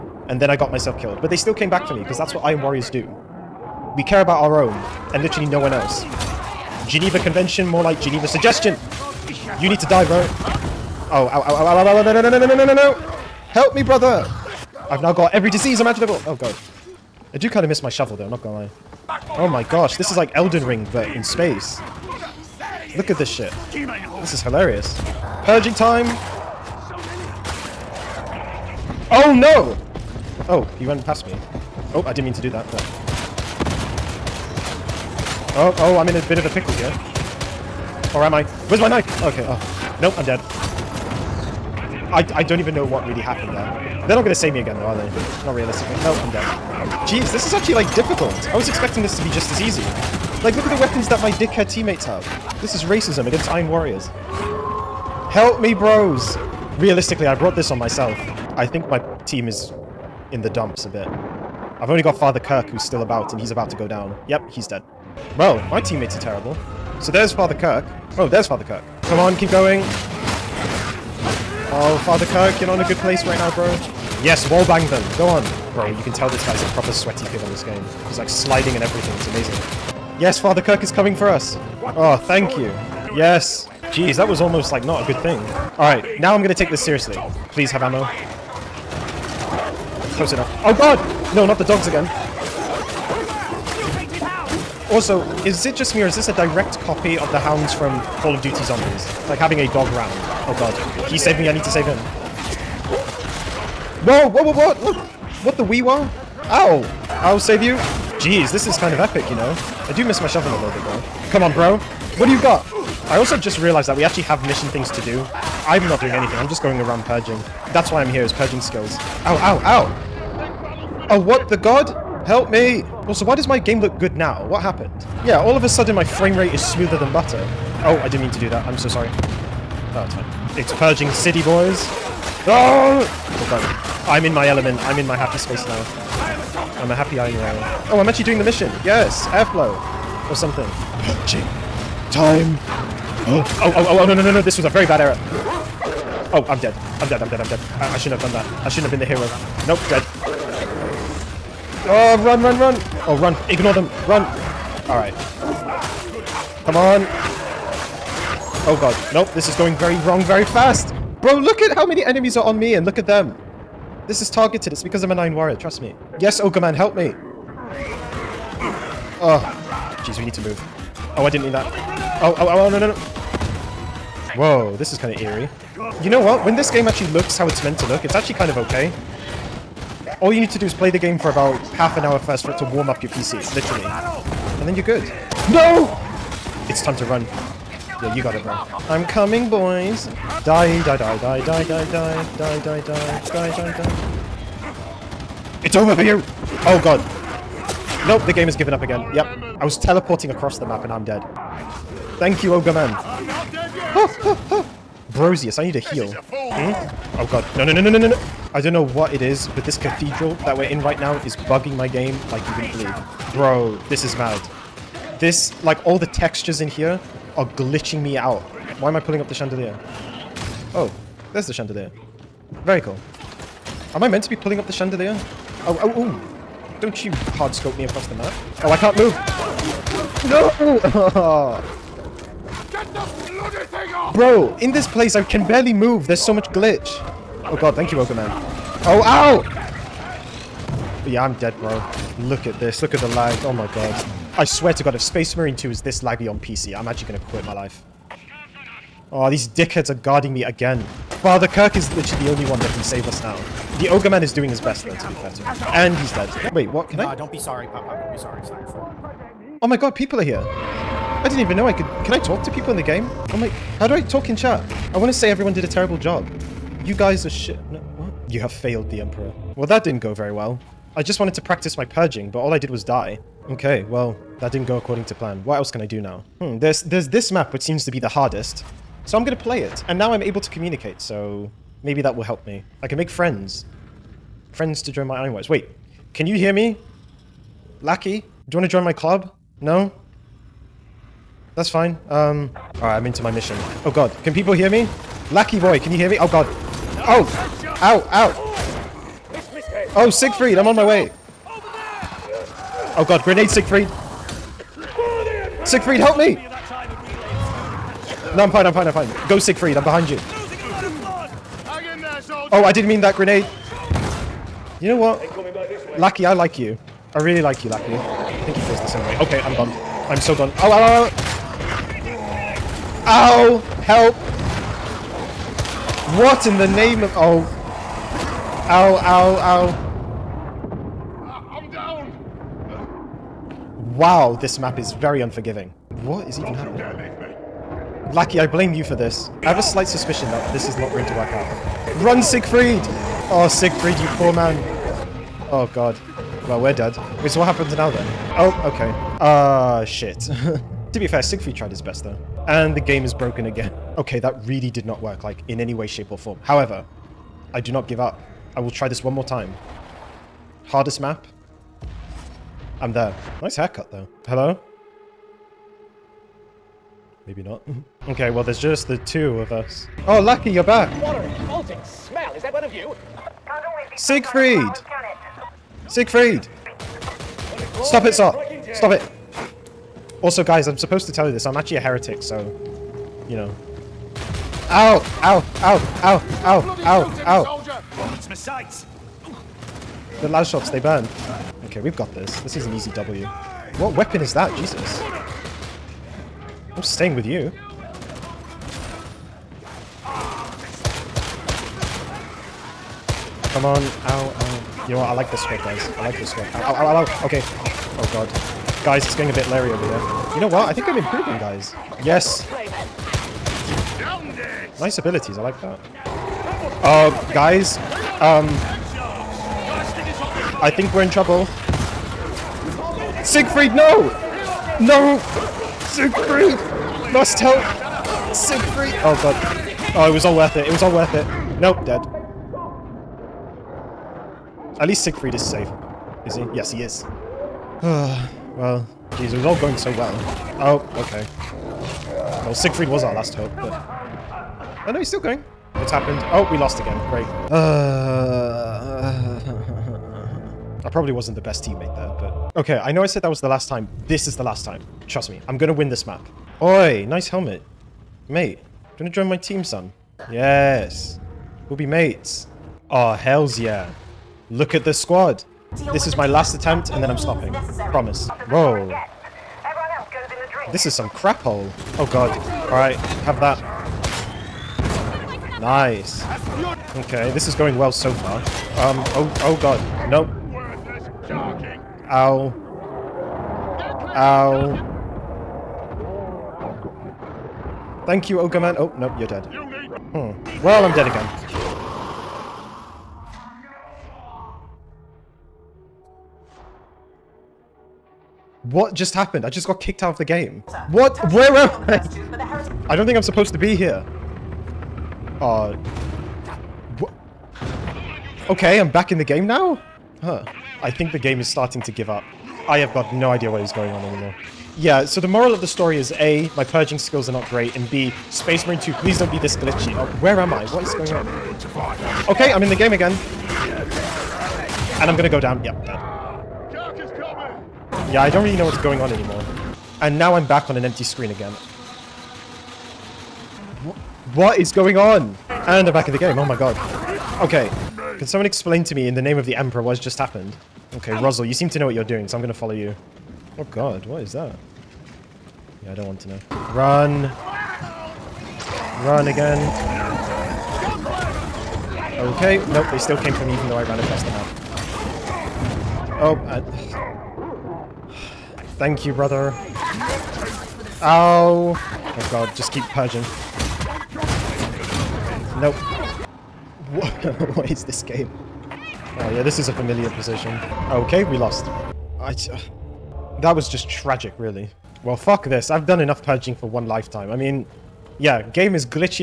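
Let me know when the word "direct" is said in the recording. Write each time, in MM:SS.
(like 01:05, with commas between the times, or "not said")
01:36.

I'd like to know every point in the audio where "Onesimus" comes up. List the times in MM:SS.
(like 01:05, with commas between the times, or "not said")
not said.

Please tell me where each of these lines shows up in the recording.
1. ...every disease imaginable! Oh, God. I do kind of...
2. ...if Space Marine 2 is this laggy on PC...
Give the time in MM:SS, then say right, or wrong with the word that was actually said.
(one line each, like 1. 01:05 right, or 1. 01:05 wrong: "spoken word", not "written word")
1. 00:15 right
2. 04:04 right.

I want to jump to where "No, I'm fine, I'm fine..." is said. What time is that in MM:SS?
05:08.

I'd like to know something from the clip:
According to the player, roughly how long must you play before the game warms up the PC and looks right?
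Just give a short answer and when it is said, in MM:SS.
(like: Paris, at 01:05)
half an hour, at 03:01.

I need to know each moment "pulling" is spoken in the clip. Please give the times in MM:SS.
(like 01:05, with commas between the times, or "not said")
03:38, 03:44.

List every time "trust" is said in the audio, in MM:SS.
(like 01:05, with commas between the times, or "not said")
02:45, 07:35.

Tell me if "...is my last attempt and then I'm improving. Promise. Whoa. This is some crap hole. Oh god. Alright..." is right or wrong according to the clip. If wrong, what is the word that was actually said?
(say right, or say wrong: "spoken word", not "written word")
wrong: "stopping", not "improving".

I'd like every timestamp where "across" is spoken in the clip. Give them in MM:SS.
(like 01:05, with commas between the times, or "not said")
03:20, 03:47, 09:13.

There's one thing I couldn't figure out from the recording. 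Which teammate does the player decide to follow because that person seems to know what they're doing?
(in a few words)
Rosal.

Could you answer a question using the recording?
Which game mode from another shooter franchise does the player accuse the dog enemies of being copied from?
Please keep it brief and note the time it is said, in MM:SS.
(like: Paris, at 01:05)
Call of Duty Zombies, at 01:38.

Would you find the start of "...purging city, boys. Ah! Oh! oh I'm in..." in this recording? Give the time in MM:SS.
02:10.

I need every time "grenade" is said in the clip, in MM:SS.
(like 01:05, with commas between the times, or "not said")
05:03, 05:13.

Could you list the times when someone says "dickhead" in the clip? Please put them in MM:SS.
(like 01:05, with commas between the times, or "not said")
00:51, 04:09.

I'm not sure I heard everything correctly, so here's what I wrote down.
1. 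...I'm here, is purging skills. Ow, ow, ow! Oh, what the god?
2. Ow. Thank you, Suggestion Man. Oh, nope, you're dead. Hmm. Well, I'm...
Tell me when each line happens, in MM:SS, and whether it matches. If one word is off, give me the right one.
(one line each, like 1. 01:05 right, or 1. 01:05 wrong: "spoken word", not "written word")
1. 01:58 right
2. 08:04 wrong: "Ogre", not "Suggestion".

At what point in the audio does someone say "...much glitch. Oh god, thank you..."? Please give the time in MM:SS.
03:56.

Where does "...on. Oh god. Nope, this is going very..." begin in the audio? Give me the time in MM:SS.
02:36.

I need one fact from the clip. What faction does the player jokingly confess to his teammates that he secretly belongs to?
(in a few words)
heretic.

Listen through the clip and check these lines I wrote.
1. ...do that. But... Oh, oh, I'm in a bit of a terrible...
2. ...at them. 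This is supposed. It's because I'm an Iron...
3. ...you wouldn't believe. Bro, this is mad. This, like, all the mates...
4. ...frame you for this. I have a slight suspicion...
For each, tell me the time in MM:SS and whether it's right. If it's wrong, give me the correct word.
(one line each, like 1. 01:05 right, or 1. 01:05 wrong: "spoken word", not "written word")
1. 00:32 wrong: "pickle", not "terrible"
2. 02:42 wrong: "targeted", not "supposed"
3. 03:32 wrong: "textures", not "mates"
4. 05:38 wrong: "blame", not "frame".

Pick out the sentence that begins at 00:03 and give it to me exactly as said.
We care about our own, and literally no one else.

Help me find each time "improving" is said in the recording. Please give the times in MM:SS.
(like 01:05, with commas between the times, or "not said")
06:50.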